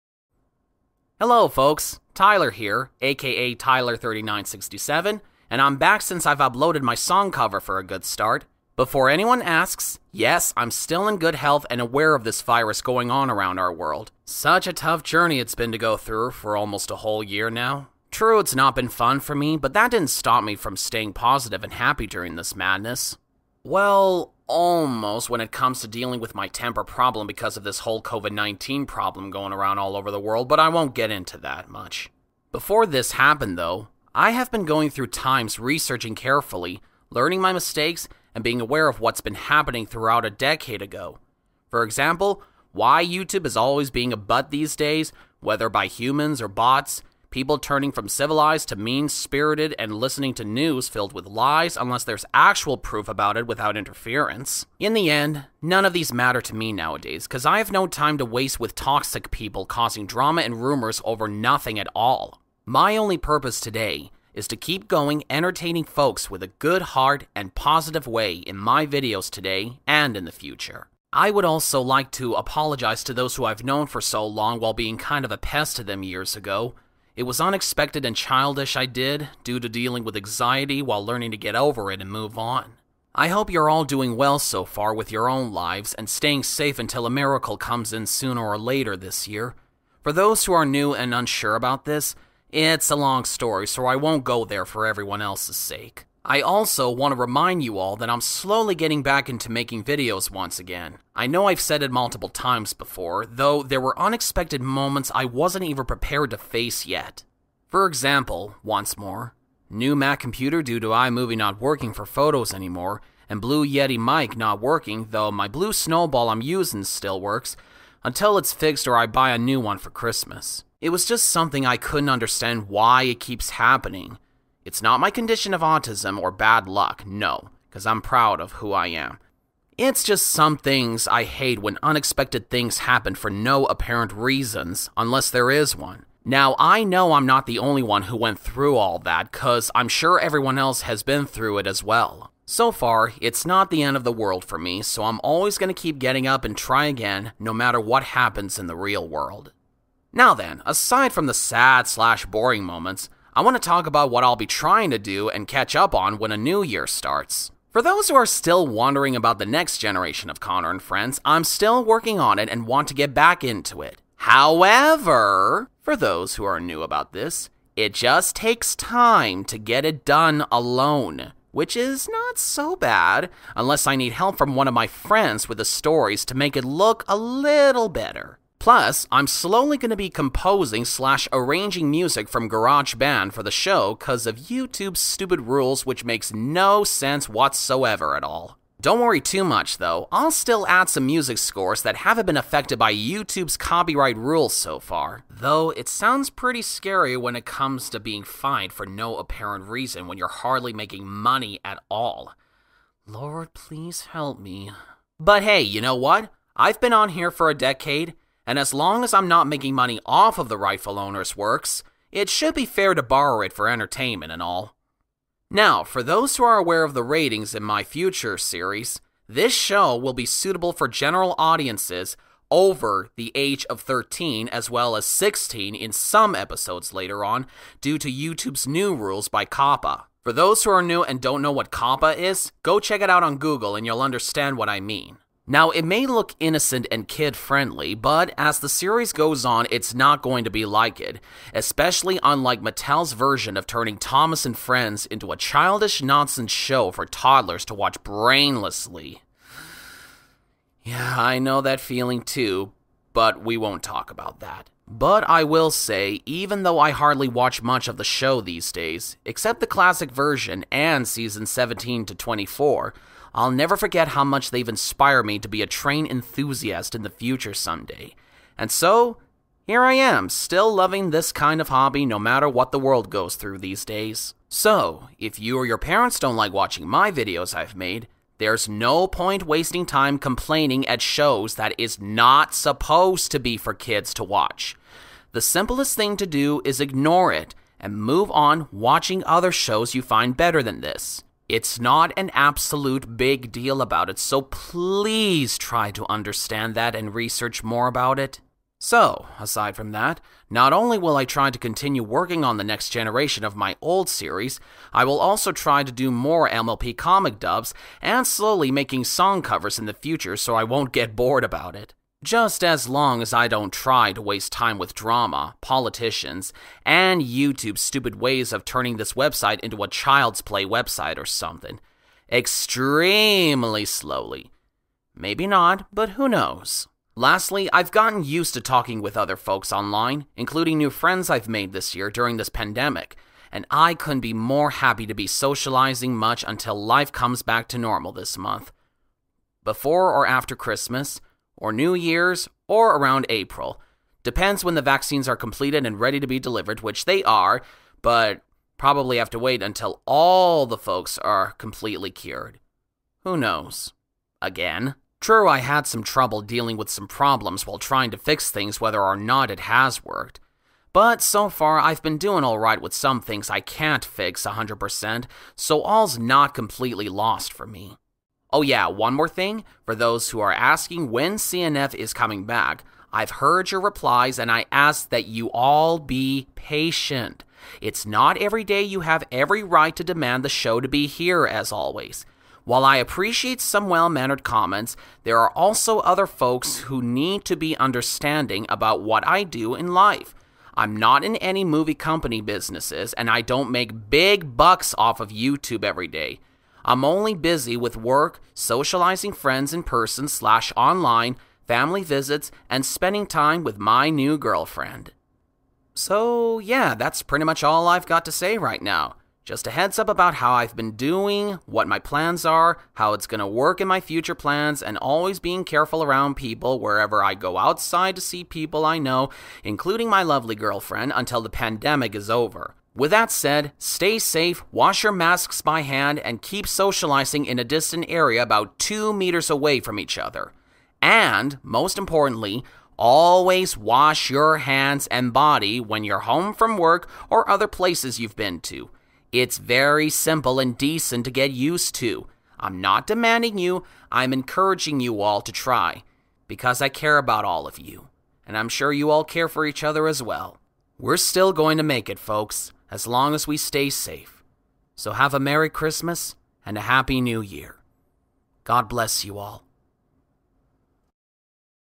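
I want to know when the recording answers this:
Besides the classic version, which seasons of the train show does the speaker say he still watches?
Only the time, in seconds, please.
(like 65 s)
261 s.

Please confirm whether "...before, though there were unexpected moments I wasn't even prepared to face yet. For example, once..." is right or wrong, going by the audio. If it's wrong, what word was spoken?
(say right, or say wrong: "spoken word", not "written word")
right.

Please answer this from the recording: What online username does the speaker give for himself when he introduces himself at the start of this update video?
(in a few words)
Tyler3967.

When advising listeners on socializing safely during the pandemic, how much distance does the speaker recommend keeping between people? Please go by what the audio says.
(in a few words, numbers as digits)
2 meters.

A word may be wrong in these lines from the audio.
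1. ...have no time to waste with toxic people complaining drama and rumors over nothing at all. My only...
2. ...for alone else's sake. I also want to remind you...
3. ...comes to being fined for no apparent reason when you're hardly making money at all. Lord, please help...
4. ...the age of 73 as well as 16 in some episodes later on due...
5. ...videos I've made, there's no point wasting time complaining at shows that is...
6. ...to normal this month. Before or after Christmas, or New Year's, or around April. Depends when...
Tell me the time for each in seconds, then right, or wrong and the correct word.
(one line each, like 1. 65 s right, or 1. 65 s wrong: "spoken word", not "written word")
1. 57 s wrong: "causing", not "complaining"
2. 94 s wrong: "everyone", not "alone"
3. 197 s right
4. 223 s wrong: "13", not "73"
5. 277 s right
6. 337 s right.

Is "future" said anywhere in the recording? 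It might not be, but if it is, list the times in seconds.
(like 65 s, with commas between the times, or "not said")
70 s, 217 s, 267 s, 309 s, 413 s.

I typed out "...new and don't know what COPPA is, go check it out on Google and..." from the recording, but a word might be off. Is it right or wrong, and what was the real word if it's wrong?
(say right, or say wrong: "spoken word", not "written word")
right.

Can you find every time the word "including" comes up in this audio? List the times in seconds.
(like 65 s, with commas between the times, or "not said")
330 s, 419 s.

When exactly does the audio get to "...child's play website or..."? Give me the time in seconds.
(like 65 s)
319 s.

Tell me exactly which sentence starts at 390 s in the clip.
I'm not in any movie company businesses, and I don't make big bucks off of YouTube every day.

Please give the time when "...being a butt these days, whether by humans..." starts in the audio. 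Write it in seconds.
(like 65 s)
43 s.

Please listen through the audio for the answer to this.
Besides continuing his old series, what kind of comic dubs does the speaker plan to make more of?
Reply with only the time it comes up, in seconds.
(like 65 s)
306 s.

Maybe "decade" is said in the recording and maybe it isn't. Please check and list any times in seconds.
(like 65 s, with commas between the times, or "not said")
40 s, 207 s.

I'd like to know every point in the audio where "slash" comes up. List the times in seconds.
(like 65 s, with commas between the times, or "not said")
151 s, 180 s, 400 s.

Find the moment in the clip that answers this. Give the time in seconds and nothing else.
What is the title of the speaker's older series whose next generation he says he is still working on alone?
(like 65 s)
160 s.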